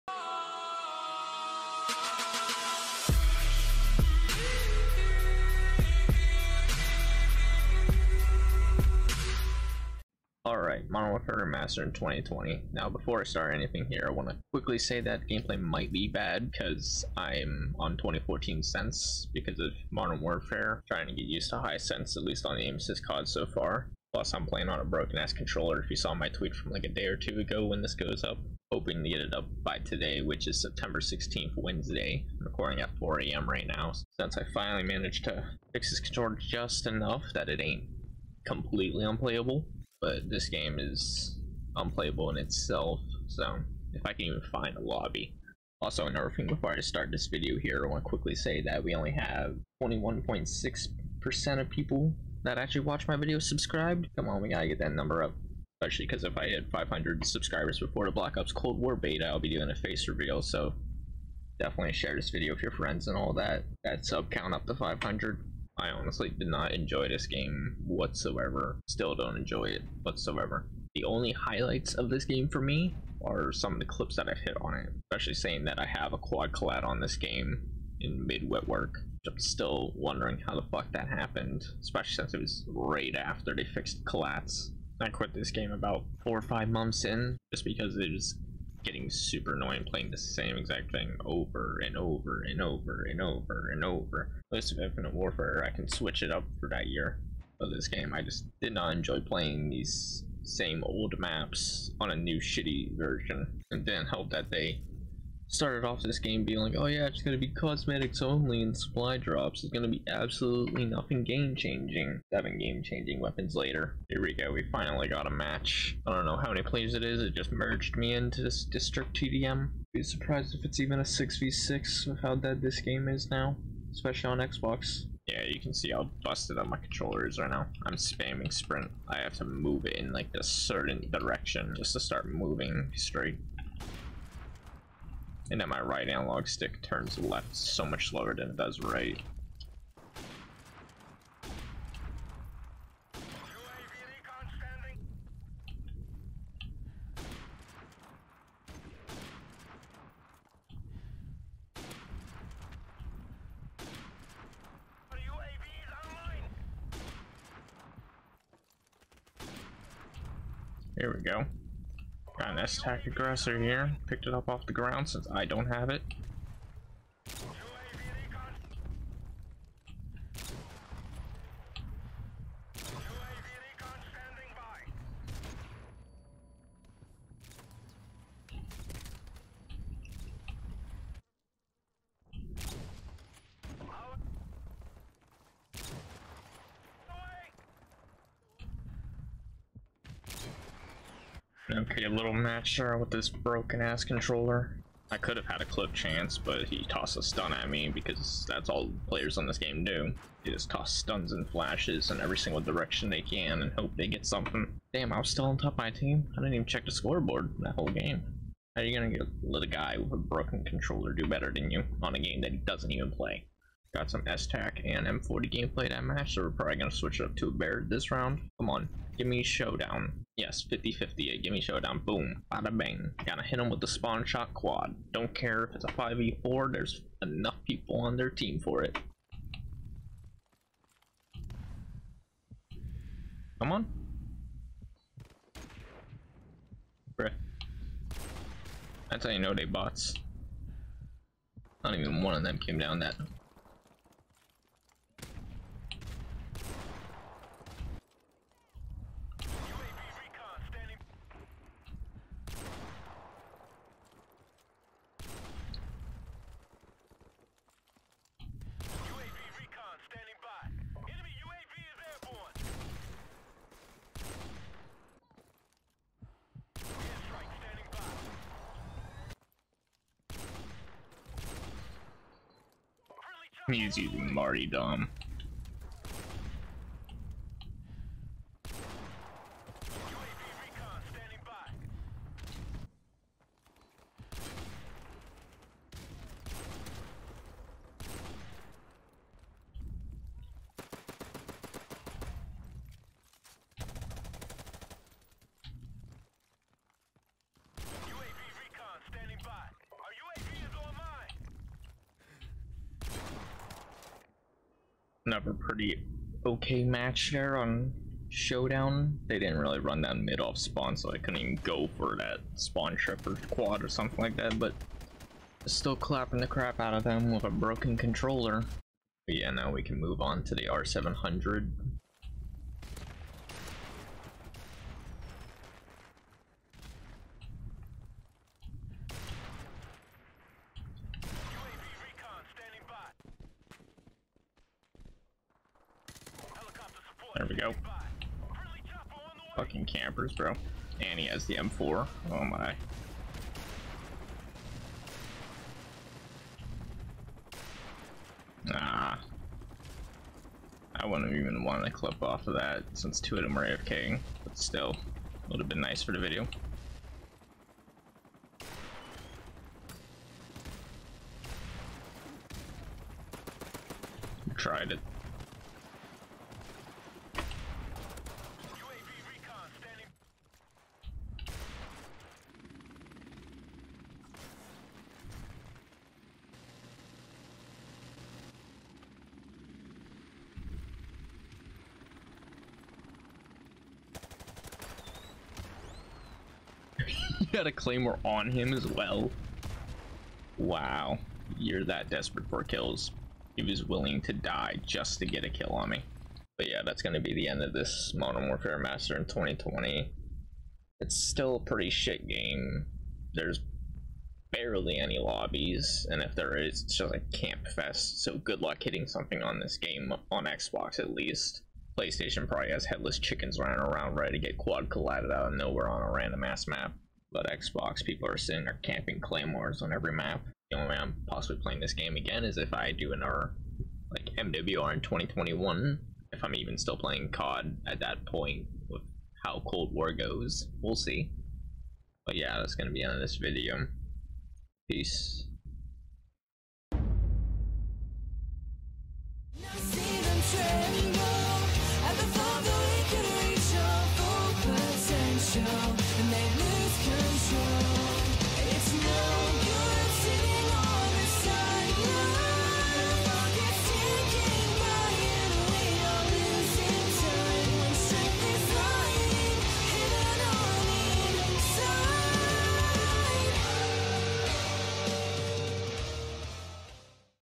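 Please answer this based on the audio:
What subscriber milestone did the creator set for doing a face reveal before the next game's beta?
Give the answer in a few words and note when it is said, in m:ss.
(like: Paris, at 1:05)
500, at 0:56.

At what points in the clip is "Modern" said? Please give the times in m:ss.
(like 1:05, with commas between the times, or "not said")
0:10, 0:19, 6:38.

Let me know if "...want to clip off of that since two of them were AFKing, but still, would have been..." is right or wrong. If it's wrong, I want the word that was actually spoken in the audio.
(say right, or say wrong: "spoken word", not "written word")
right.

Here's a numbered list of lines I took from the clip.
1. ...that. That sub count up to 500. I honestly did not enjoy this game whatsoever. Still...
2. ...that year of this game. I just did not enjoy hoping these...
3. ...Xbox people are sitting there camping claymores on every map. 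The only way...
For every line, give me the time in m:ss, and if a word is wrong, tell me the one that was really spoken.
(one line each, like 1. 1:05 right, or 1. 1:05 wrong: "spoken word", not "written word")
1. 1:03 right
2. 1:36 wrong: "playing", not "hoping"
3. 6:57 right.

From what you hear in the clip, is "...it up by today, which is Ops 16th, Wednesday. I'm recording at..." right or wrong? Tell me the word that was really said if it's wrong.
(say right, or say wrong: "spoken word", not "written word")
wrong: "September", not "Ops".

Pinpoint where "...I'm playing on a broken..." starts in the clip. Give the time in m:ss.
0:24.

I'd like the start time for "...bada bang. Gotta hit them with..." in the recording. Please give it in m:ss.
3:42.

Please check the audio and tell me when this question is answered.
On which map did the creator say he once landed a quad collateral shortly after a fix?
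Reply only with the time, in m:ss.
1:18.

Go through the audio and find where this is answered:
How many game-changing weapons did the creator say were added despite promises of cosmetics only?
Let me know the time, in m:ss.
1:52.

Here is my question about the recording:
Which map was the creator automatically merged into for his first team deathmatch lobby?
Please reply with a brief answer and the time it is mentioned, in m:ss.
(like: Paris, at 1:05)
District, at 1:58.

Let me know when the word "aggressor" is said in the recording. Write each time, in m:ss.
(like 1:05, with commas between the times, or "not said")
2:43.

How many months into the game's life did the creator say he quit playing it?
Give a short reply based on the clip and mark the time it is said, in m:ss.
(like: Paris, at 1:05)
four or five, at 1:26.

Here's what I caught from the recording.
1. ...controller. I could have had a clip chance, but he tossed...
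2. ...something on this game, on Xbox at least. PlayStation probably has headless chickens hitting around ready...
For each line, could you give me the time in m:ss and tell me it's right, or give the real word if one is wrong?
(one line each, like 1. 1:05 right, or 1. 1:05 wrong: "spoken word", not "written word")
1. 3:14 right
2. 6:49 wrong: "running", not "hitting".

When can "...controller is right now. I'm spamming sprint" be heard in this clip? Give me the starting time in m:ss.
2:06.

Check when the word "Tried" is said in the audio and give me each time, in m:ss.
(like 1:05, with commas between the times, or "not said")
6:04.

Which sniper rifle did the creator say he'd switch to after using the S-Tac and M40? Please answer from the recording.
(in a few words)
Barrett.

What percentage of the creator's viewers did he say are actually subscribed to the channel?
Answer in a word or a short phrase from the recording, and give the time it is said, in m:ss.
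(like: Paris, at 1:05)
21.6%, at 0:49.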